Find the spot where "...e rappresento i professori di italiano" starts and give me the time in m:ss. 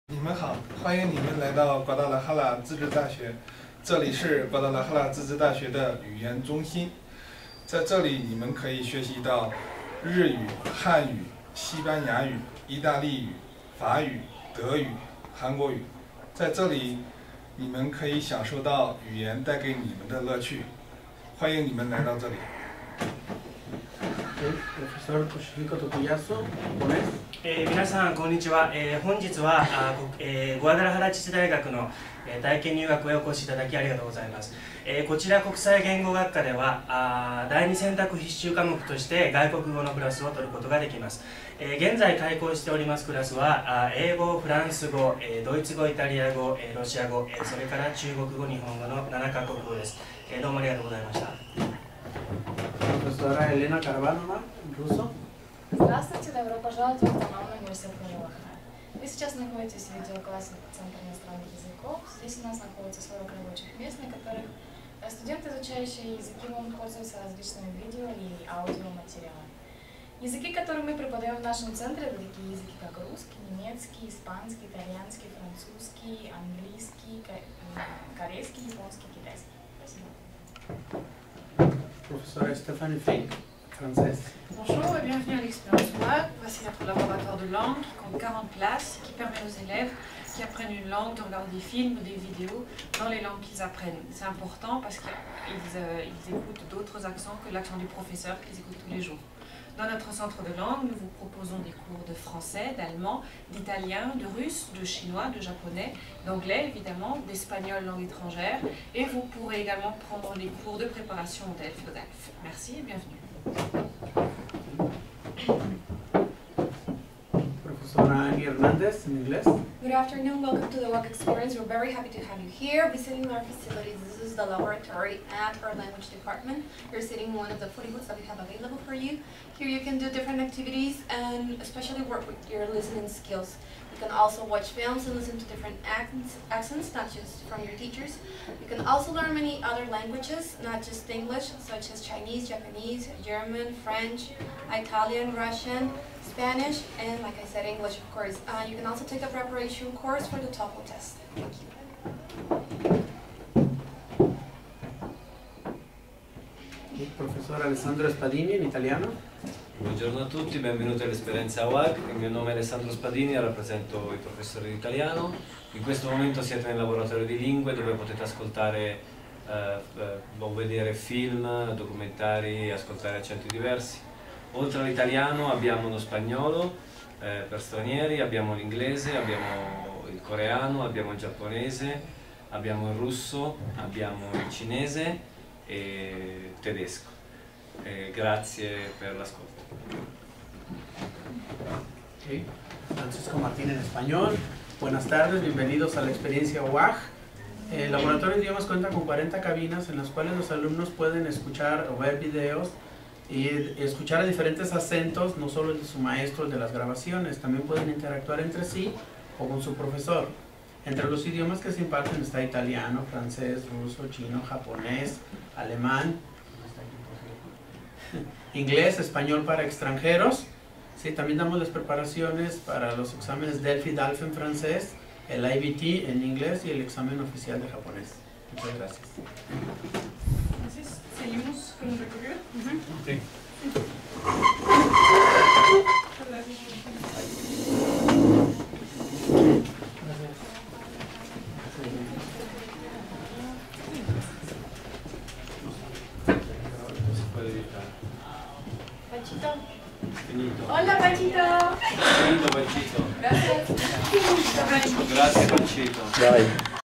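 2:43.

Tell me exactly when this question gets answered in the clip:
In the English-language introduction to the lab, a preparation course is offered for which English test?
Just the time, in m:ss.
2:30.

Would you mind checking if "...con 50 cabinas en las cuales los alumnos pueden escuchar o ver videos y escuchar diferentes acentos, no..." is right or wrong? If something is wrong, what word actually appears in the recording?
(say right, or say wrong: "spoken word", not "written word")
wrong: "40", not "50".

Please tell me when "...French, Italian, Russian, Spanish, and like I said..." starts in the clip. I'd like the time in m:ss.
2:23.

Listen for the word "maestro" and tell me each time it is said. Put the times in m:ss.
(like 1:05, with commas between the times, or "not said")
3:25.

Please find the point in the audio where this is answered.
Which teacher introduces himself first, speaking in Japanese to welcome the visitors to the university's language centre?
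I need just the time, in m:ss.
0:25.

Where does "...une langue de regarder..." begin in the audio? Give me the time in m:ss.
1:30.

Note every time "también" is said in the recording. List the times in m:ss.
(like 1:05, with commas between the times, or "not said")
3:27, 3:41.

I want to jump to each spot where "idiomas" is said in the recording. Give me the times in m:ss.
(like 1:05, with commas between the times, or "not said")
3:18, 3:31.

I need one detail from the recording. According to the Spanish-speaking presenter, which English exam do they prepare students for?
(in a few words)
IBT.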